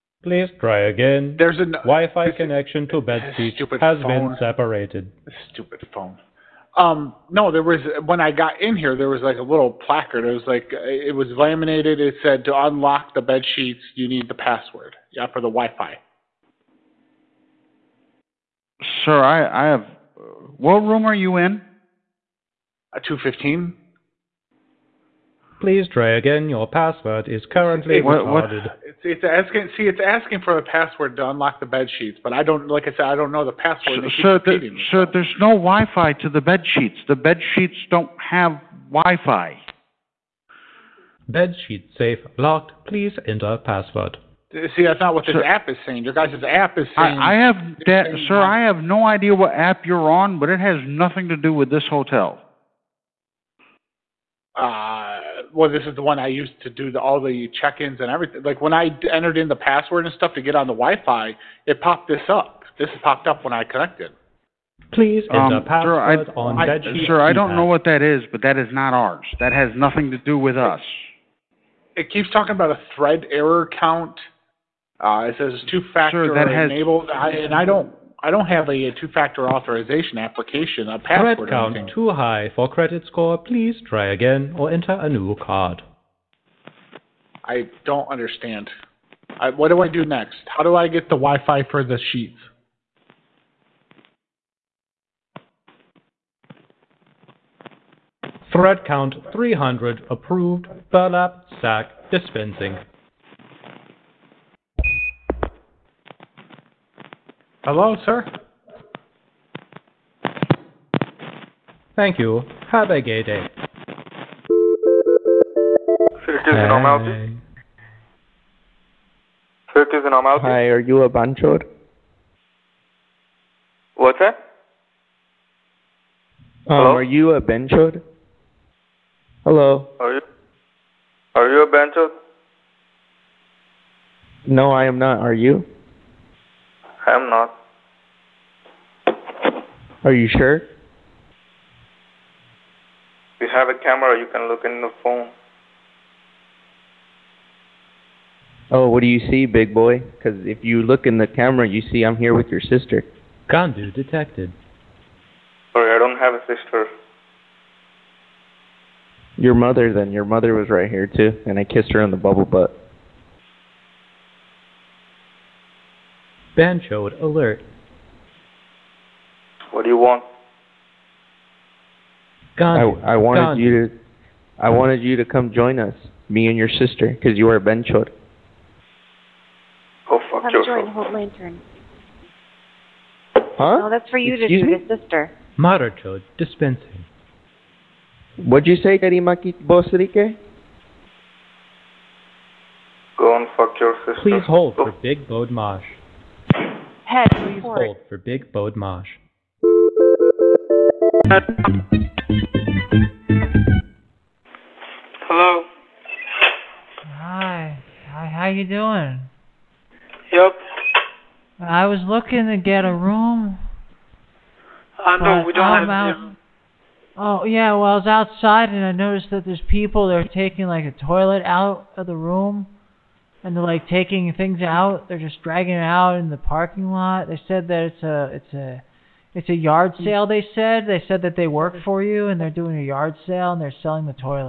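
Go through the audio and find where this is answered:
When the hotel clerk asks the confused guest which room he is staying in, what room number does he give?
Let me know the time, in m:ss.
0:23.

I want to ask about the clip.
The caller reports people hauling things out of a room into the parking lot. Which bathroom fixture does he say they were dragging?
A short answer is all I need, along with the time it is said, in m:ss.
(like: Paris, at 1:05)
Toilet, at 3:41.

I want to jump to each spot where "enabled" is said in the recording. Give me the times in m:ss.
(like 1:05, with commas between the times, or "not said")
1:16.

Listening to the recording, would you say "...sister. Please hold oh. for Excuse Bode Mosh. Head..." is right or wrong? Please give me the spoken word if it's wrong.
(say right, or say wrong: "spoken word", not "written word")
wrong: "Big", not "Excuse".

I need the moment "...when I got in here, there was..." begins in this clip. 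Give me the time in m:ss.
0:08.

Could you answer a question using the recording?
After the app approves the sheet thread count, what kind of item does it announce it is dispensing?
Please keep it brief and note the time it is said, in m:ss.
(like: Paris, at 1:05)
Burlap sack, at 1:40.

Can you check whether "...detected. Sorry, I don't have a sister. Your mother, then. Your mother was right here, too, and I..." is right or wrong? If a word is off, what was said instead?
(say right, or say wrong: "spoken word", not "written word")
right.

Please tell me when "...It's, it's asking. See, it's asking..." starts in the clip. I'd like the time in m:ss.
0:28.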